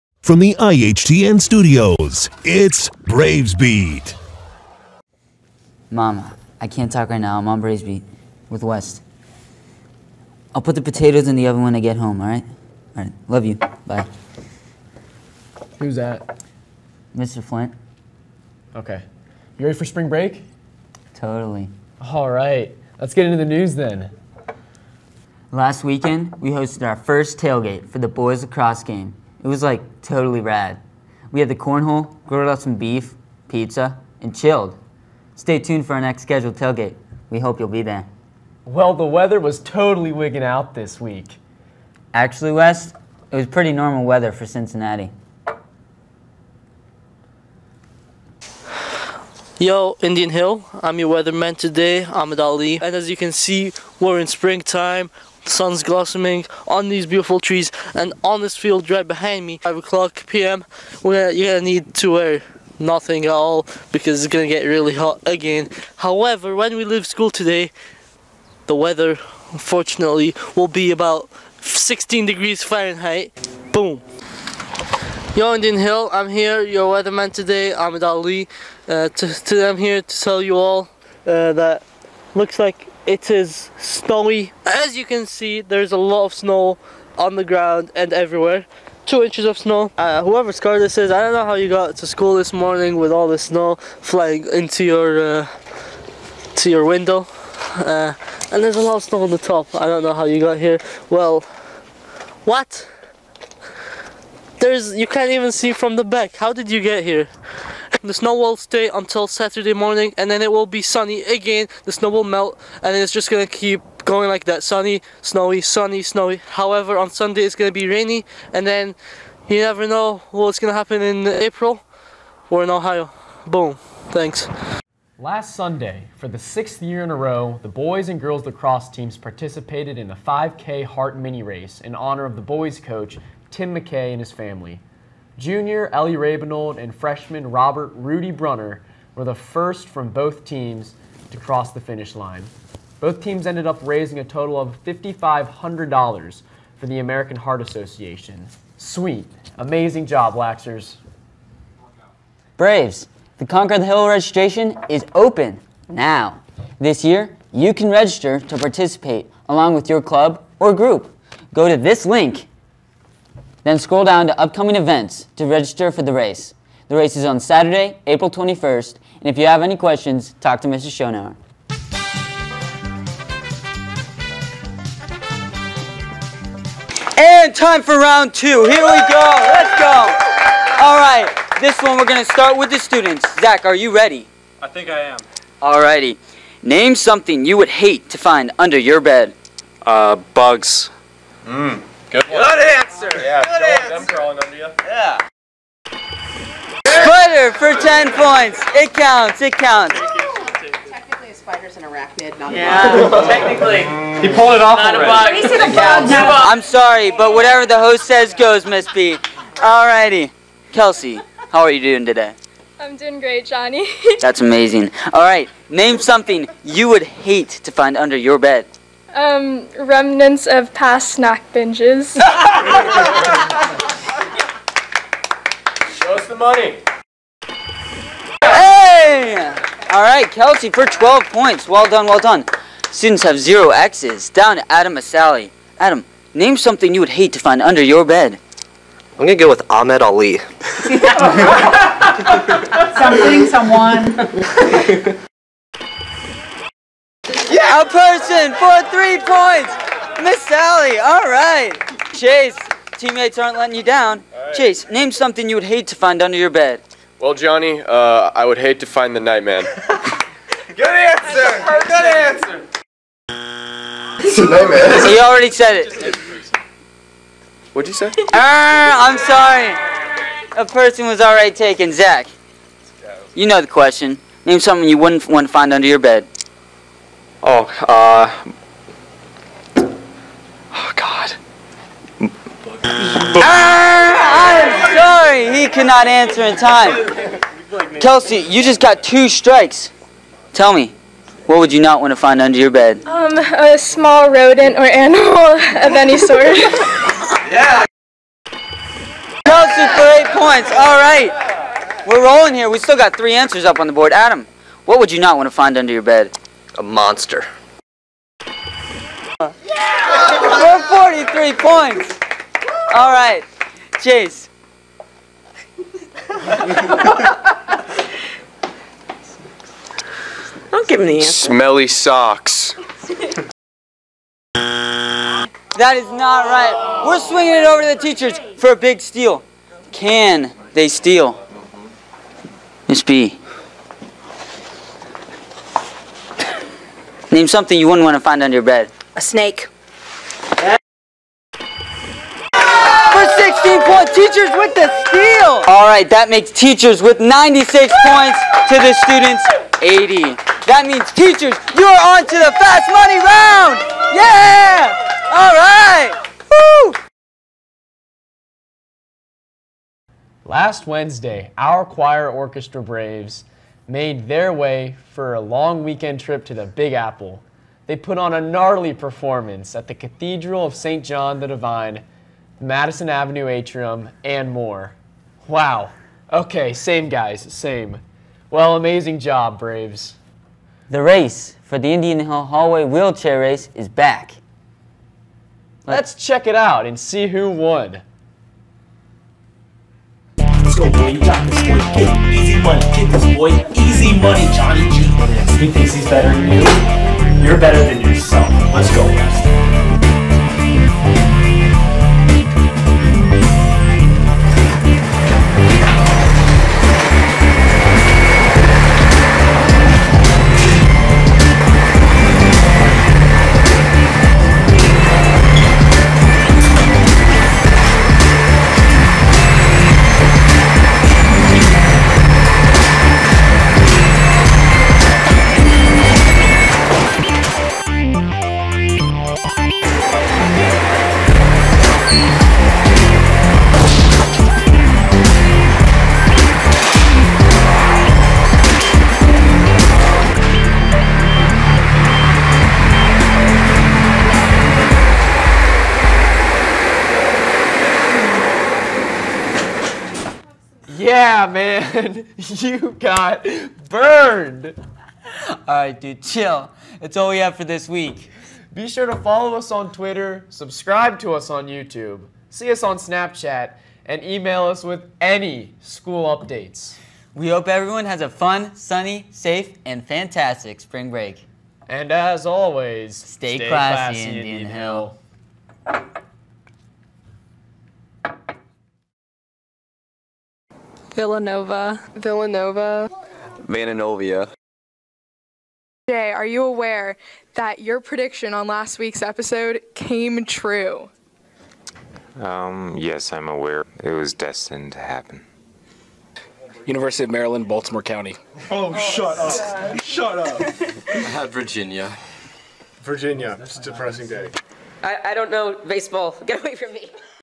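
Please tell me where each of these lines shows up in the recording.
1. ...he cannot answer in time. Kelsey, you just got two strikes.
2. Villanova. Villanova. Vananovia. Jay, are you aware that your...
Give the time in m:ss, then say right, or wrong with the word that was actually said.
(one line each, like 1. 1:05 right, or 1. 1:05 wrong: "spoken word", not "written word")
1. 4:45 right
2. 8:01 right.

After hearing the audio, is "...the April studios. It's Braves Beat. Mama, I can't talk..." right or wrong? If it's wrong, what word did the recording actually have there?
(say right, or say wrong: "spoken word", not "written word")
wrong: "IHTN", not "April".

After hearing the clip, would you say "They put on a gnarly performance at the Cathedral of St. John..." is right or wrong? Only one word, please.
right.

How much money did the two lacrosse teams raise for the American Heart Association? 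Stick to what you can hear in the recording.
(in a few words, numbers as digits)
$5,500.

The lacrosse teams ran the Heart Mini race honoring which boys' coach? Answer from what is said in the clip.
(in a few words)
Tim McKay.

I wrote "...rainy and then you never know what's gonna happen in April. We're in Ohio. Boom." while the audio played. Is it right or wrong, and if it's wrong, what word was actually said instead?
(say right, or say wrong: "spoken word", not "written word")
right.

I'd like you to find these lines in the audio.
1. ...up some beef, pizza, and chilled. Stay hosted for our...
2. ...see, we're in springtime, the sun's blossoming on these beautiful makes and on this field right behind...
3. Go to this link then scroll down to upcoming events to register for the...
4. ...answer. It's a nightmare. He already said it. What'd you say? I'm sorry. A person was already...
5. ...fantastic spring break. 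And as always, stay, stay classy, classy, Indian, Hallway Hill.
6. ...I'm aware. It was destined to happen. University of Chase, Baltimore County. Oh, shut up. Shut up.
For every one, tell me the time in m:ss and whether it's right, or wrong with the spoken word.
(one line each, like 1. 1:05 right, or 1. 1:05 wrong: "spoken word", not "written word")
1. 0:32 wrong: "tuned", not "hosted"
2. 0:53 wrong: "trees", not "makes"
3. 2:41 right
4. 4:22 right
5. 7:50 wrong: "Indian", not "Hallway"
6. 8:13 wrong: "Maryland", not "Chase".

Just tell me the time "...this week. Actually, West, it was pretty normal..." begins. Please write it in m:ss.
0:40.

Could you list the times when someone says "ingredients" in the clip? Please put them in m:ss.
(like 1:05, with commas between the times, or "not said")
not said.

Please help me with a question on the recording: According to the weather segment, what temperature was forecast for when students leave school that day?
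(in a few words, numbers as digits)
16 degrees Fahrenheit.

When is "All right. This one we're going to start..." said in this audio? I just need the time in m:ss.
3:00.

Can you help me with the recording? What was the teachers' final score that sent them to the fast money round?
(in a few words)
96.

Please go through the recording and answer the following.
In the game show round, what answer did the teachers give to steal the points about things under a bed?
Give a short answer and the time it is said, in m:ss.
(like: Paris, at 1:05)
A snake, at 5:39.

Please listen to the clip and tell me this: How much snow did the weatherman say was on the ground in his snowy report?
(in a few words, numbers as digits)
2 inches.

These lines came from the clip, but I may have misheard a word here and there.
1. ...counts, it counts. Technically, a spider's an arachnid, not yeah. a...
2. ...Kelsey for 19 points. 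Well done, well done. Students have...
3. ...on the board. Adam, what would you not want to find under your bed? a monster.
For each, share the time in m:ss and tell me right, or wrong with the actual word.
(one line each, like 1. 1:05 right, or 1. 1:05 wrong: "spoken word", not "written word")
1. 3:18 right
2. 3:50 wrong: "12", not "19"
3. 5:03 right.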